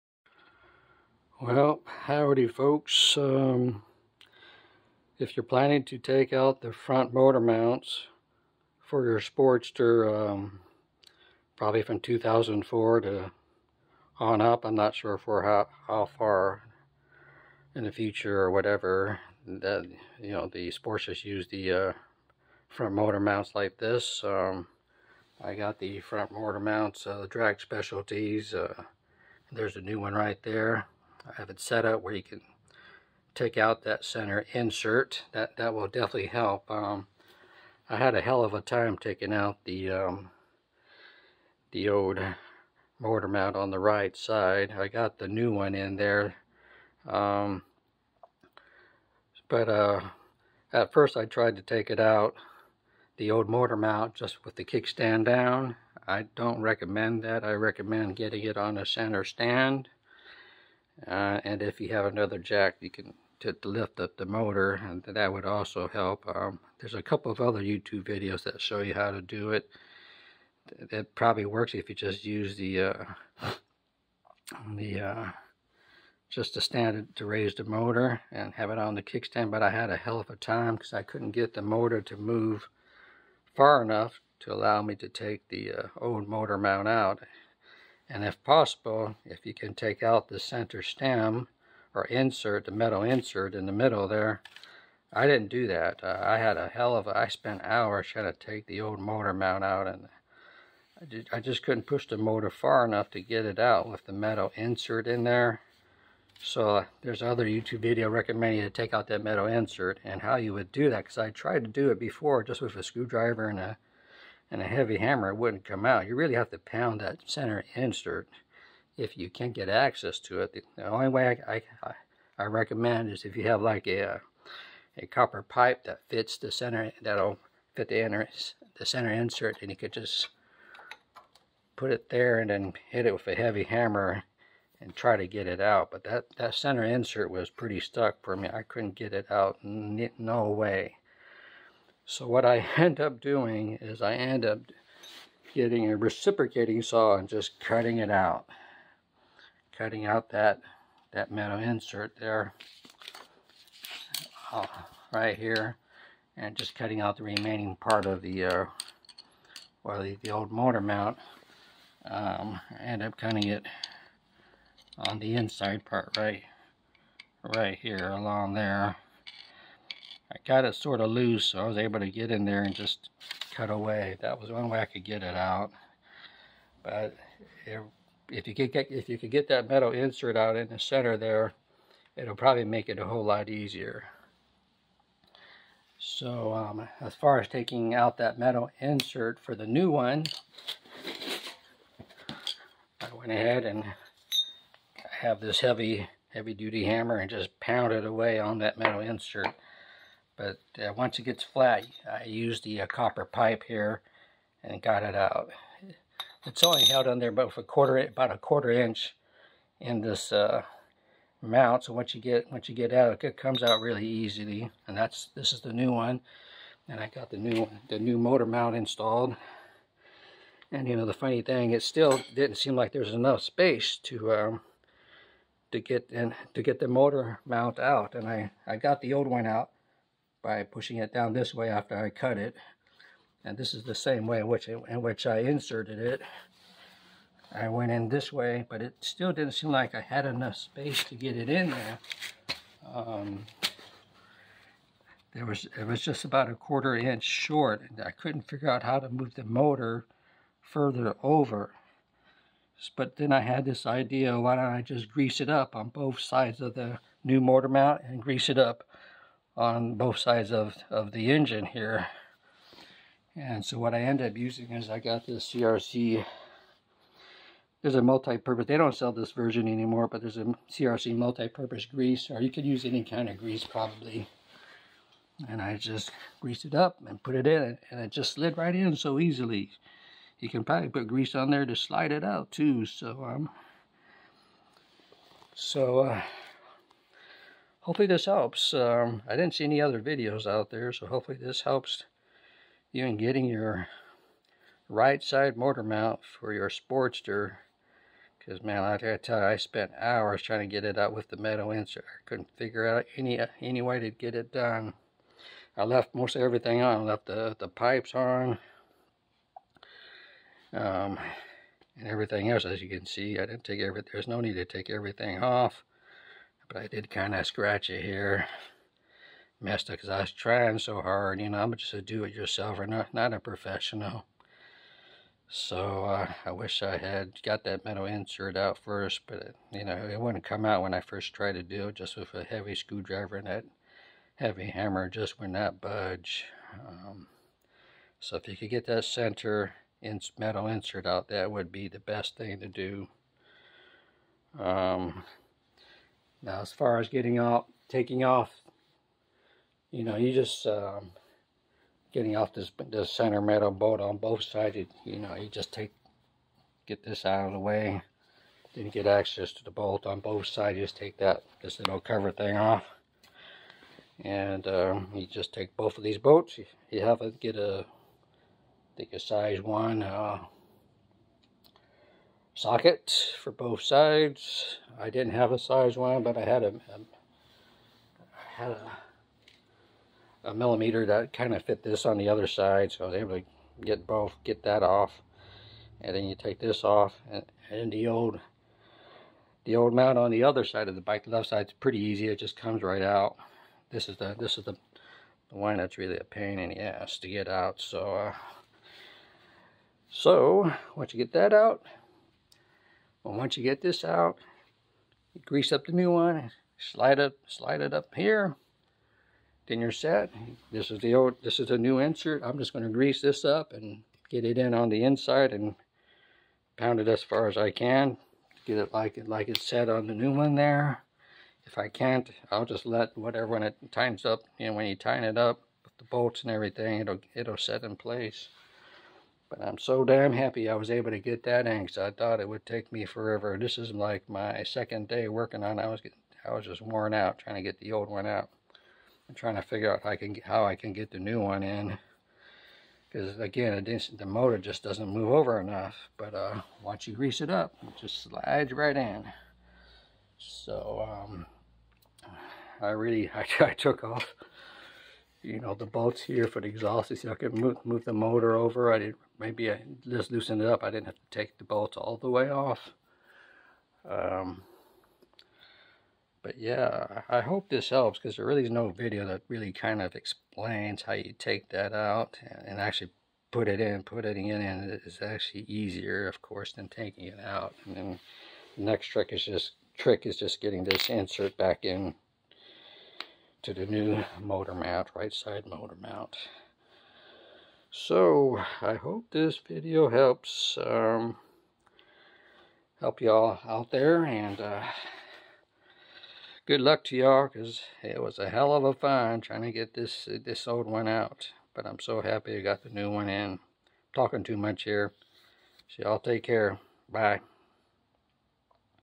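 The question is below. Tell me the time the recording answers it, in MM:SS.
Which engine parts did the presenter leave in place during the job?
05:07.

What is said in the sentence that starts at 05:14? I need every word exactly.
There's no need to take everything off.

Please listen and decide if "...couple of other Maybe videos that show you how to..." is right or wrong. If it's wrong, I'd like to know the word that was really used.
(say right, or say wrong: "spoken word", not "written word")
wrong: "YouTube", not "Maybe".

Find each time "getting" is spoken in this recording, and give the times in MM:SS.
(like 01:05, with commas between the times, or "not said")
00:58, 02:25, 04:53, 05:47, 05:52, 07:15, 08:00.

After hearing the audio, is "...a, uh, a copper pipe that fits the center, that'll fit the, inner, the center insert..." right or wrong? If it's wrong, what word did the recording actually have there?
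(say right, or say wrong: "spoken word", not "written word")
right.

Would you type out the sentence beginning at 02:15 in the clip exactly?
But that, that center insert was pretty stuck for me.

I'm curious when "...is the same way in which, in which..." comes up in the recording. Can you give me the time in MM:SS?
03:53.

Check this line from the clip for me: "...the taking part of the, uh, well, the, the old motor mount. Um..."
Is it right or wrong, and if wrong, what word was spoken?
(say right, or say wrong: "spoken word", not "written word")
wrong: "remaining", not "taking".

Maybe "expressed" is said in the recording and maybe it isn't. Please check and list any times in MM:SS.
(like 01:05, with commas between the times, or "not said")
not said.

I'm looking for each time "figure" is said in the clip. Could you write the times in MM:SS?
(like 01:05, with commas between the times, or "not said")
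04:08, 05:02, 07:19.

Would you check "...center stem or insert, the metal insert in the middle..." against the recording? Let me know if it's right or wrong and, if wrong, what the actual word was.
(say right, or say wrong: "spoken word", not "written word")
right.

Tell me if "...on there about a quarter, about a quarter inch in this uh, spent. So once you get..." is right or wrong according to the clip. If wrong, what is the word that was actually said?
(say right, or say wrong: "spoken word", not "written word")
wrong: "mount", not "spent".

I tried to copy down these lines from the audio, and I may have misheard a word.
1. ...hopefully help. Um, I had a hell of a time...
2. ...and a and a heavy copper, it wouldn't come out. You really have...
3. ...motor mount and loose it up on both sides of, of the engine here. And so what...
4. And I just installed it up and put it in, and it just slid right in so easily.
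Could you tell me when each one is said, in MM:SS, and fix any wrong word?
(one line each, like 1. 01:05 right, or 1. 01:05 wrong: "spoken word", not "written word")
1. 00:35 wrong: "definitely", not "hopefully"
2. 01:53 wrong: "hammer", not "copper"
3. 04:17 wrong: "grease", not "loose"
4. 04:35 wrong: "greased", not "installed".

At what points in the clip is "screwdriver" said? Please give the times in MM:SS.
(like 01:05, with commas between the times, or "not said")
01:52, 05:32.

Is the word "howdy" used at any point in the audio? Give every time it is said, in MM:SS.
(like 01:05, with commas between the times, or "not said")
00:02.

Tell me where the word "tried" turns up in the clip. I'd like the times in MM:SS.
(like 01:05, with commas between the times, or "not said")
00:51, 01:51, 05:31.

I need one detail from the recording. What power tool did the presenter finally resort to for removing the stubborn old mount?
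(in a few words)
reciprocating saw.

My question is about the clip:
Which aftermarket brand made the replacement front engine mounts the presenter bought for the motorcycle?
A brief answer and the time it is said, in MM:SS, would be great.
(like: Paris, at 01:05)
Drag Specialties, at 00:27.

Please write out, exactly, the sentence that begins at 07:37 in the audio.
You see, I could move, move the motor over.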